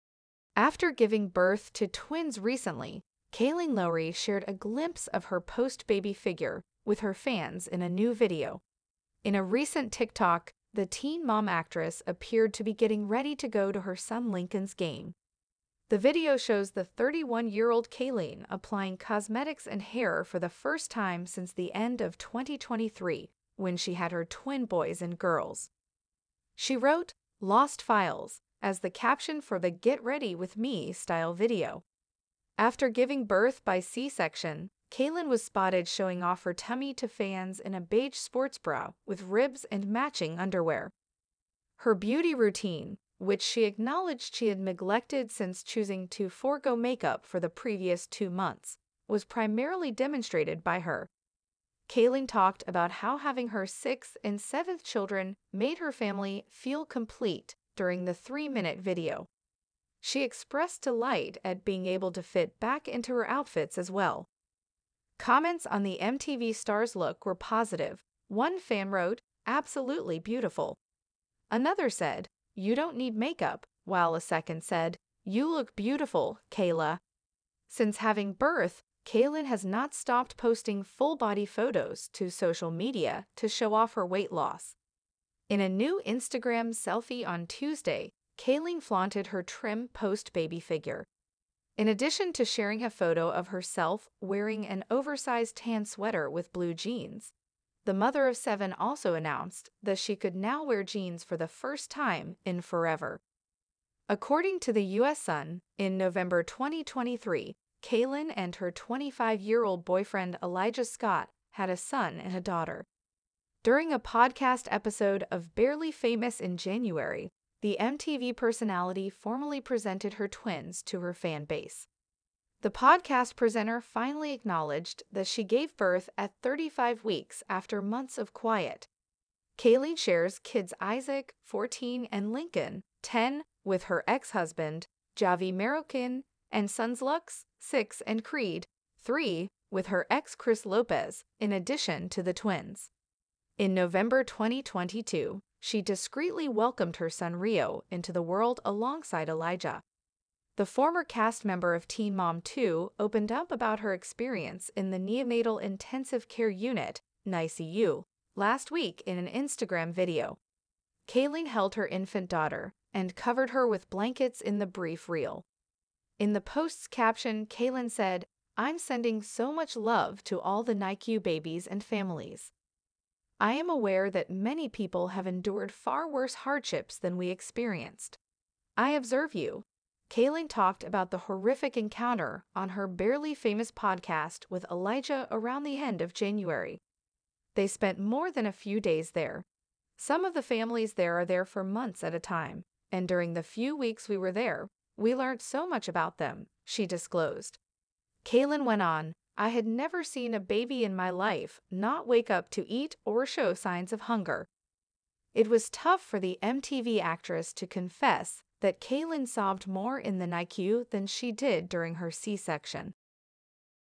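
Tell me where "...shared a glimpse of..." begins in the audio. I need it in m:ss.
0:04.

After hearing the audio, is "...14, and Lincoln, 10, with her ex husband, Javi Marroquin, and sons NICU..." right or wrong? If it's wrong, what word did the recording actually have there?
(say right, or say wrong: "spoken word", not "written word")
wrong: "Lux", not "NICU".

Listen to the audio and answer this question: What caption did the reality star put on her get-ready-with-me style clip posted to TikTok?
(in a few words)
Lost Files.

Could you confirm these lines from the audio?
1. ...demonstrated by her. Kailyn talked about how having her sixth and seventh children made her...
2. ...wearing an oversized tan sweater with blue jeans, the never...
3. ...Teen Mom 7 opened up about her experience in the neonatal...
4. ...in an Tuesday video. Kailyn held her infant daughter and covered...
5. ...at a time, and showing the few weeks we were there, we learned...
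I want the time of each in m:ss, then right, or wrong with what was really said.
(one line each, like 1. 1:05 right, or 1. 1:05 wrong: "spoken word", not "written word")
1. 0:49 right
2. 1:34 wrong: "mother", not "never"
3. 2:31 wrong: "2", not "7"
4. 2:39 wrong: "Instagram", not "Tuesday"
5. 3:12 wrong: "during", not "showing".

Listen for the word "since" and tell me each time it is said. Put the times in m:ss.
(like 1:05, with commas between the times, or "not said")
0:21, 0:45, 1:17.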